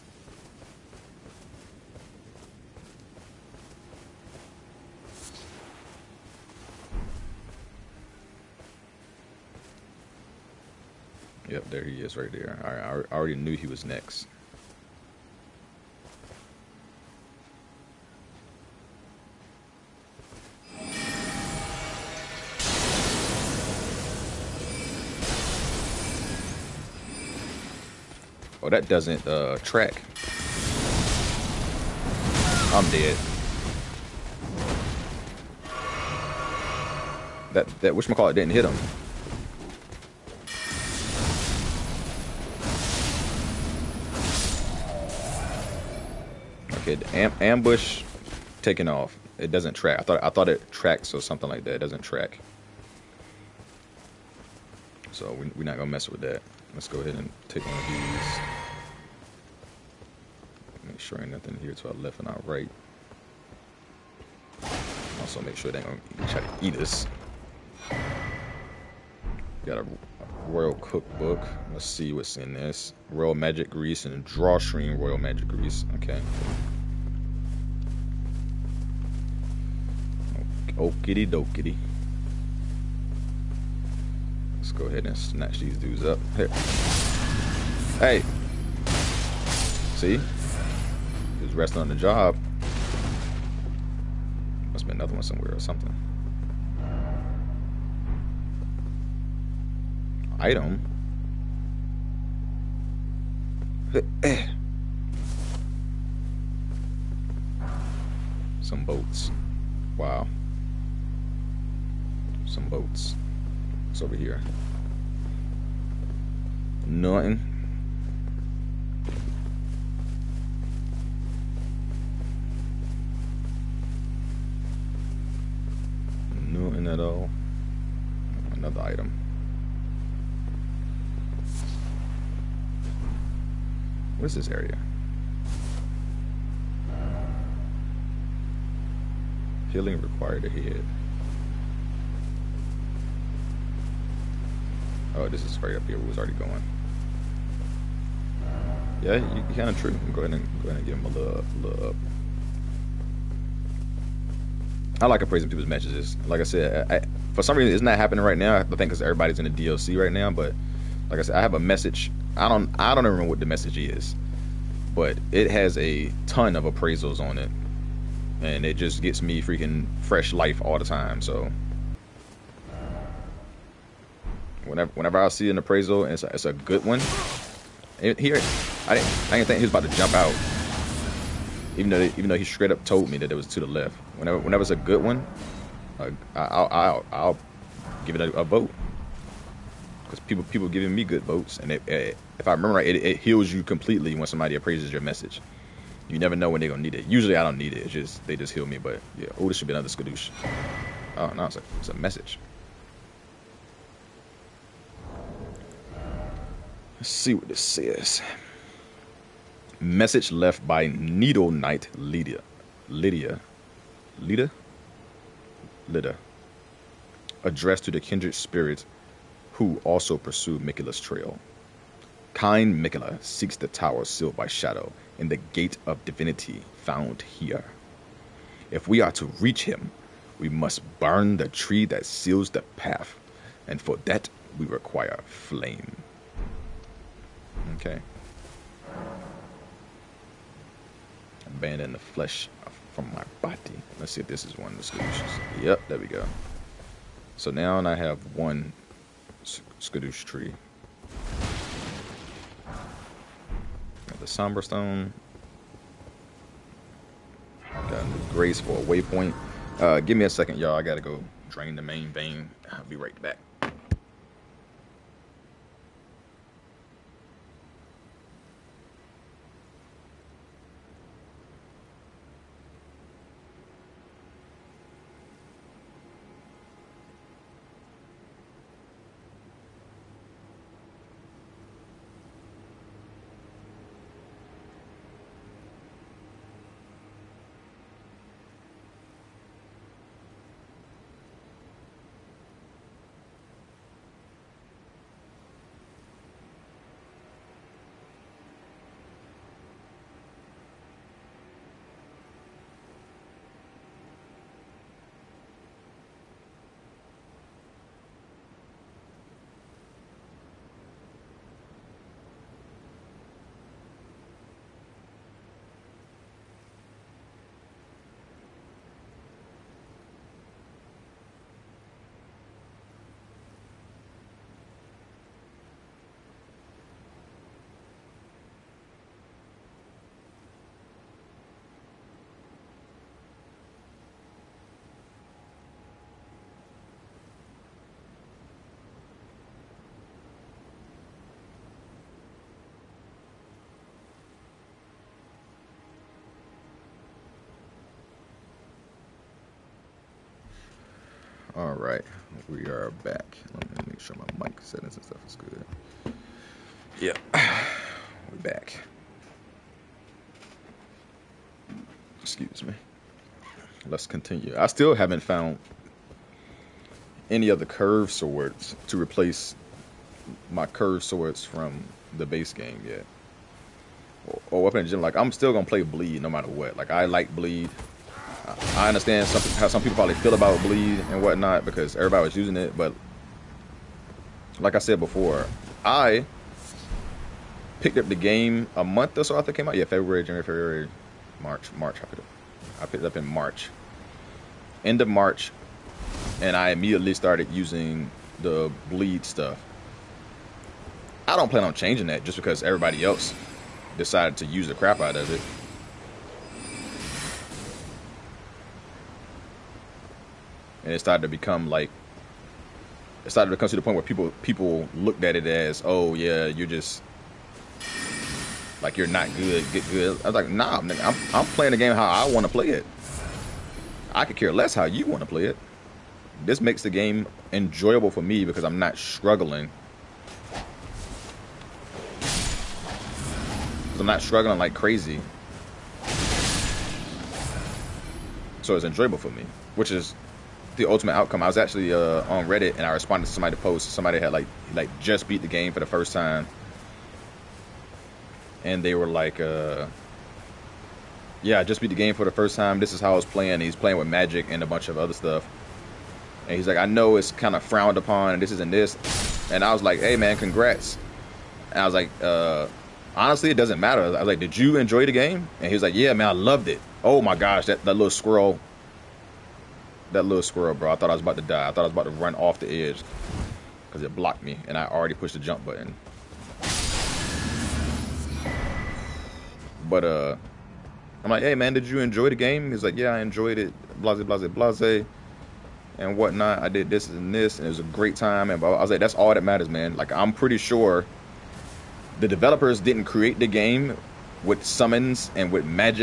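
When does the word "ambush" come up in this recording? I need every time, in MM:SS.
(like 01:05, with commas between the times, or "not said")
00:47.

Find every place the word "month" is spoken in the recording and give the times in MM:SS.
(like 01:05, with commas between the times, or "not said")
06:28.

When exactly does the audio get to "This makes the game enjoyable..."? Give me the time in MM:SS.
07:06.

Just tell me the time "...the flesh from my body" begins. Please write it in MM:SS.
04:01.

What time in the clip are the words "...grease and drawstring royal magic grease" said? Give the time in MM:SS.
01:13.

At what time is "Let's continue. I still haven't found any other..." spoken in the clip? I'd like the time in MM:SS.
06:03.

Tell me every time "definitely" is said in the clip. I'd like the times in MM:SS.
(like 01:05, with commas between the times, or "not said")
not said.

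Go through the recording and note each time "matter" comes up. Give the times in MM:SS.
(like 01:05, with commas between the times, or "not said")
06:16, 07:43, 08:09.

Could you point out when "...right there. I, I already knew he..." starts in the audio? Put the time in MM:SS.
00:12.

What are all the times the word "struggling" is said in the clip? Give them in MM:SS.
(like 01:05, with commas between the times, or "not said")
07:08, 07:14.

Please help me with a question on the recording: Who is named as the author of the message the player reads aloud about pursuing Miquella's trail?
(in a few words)
Needle Knight Lydia.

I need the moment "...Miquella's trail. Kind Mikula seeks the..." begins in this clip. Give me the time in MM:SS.
03:40.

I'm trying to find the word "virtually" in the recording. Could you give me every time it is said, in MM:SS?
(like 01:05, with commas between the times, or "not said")
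not said.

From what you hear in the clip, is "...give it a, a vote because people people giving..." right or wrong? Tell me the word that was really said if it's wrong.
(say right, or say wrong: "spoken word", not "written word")
right.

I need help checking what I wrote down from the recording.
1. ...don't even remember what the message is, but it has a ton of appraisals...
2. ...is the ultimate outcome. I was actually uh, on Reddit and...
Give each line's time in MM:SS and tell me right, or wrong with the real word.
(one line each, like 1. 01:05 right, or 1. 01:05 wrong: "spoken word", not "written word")
1. 02:42 right
2. 07:19 right.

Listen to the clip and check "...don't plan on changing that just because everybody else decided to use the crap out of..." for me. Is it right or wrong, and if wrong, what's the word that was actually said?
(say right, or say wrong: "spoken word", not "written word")
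right.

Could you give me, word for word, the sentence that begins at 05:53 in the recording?
Let me make sure my mic settings and stuff is good.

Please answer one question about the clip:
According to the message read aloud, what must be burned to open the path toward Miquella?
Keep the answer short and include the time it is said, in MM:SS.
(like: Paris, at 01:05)
The tree, at 03:50.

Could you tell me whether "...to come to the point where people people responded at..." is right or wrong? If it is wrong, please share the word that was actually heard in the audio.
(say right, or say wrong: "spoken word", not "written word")
wrong: "looked", not "responded".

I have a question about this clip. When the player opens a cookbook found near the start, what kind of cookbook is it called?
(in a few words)
Royal cookbook.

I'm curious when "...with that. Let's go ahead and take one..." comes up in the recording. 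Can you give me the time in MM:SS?
00:56.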